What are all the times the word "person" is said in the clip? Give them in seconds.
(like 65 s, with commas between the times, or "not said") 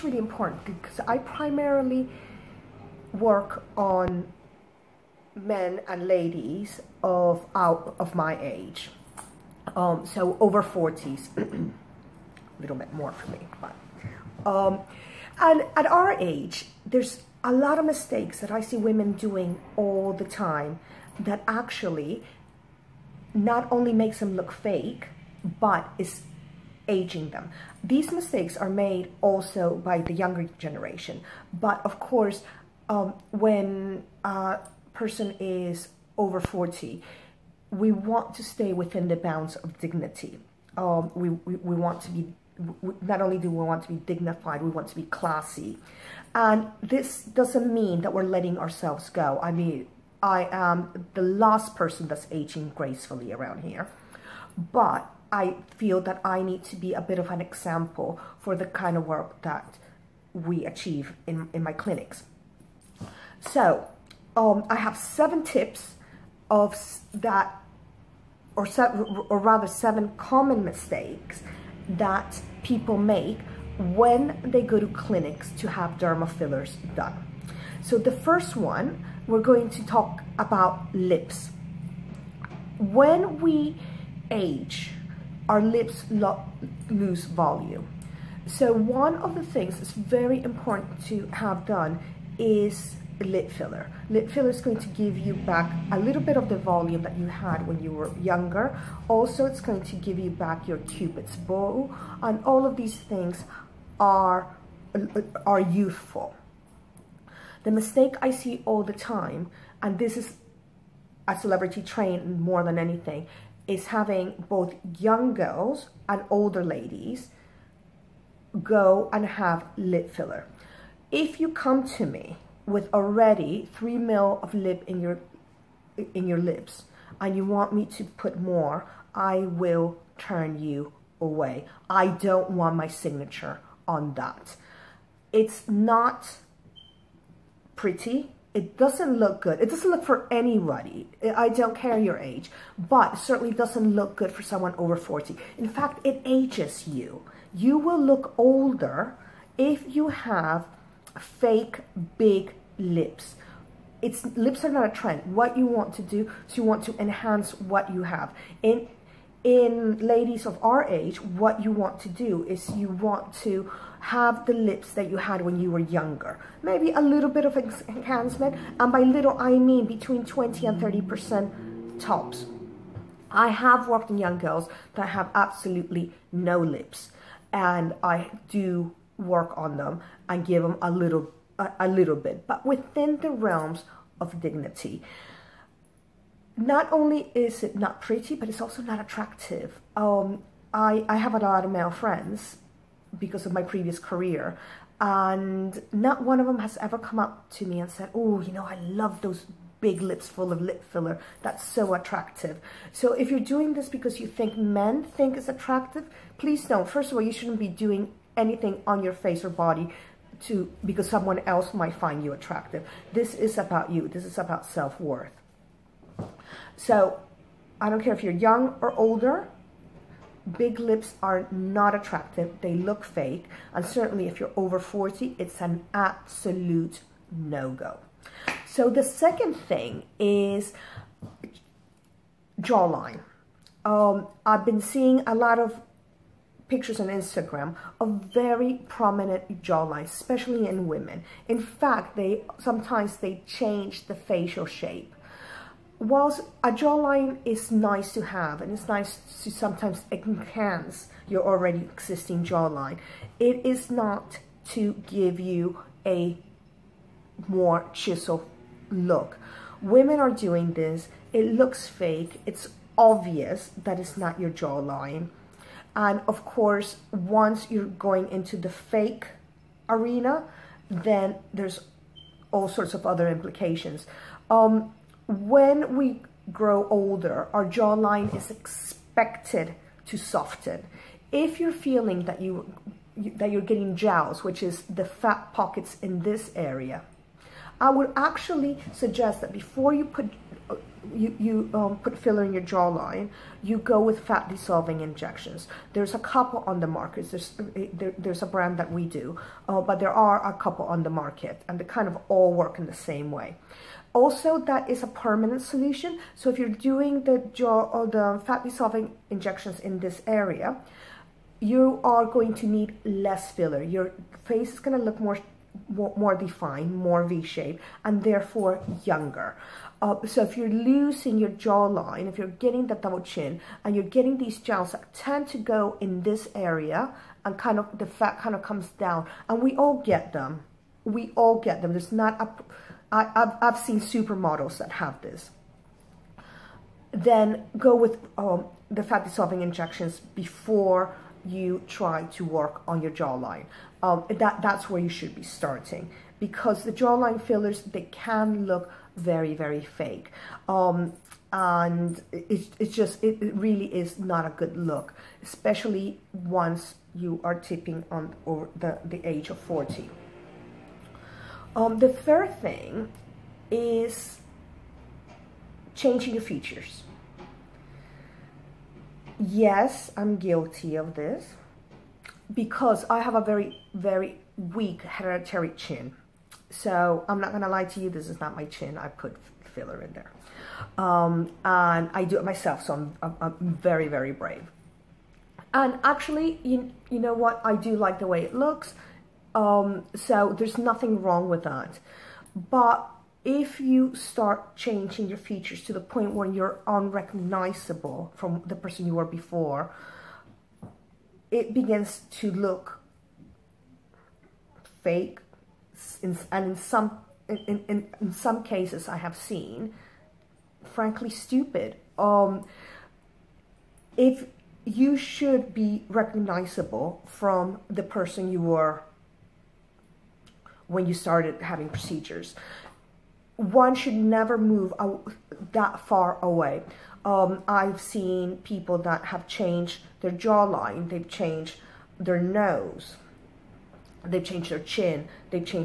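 34 s, 51 s, 398 s, 418 s.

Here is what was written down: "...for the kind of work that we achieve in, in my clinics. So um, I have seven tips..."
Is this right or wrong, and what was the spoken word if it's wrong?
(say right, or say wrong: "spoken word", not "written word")
right.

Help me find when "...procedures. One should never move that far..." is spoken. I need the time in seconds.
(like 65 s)
421 s.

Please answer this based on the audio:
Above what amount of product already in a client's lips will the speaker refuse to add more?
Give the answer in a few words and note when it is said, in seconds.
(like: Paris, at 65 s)
3 ml, at 123 s.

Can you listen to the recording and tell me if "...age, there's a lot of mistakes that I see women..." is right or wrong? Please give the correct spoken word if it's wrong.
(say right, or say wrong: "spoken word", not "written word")
right.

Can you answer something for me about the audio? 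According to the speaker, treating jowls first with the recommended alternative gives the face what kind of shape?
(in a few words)
V-shaped.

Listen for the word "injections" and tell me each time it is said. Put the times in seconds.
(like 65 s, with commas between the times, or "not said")
294 s, 309 s, 339 s.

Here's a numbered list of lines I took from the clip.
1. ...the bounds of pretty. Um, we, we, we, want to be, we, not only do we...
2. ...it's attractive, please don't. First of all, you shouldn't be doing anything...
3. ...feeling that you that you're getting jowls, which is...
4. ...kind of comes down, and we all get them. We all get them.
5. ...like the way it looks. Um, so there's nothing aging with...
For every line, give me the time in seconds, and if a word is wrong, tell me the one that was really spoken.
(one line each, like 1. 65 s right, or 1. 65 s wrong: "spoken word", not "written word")
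1. 39 s wrong: "dignity", not "pretty"
2. 205 s right
3. 281 s right
4. 328 s right
5. 387 s wrong: "wrong", not "aging".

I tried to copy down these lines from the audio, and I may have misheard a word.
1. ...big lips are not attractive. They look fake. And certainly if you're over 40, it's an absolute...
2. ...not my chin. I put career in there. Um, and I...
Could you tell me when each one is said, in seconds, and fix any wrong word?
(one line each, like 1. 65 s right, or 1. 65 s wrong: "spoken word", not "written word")
1. 220 s right
2. 378 s wrong: "filler", not "career".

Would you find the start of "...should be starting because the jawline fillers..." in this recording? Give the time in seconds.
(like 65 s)
345 s.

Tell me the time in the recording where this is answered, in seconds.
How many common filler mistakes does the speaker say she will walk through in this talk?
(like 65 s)
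69 s.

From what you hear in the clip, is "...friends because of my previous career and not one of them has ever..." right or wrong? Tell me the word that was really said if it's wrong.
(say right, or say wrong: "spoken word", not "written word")
right.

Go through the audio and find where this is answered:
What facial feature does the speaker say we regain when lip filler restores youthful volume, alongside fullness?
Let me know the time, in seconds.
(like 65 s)
100 s.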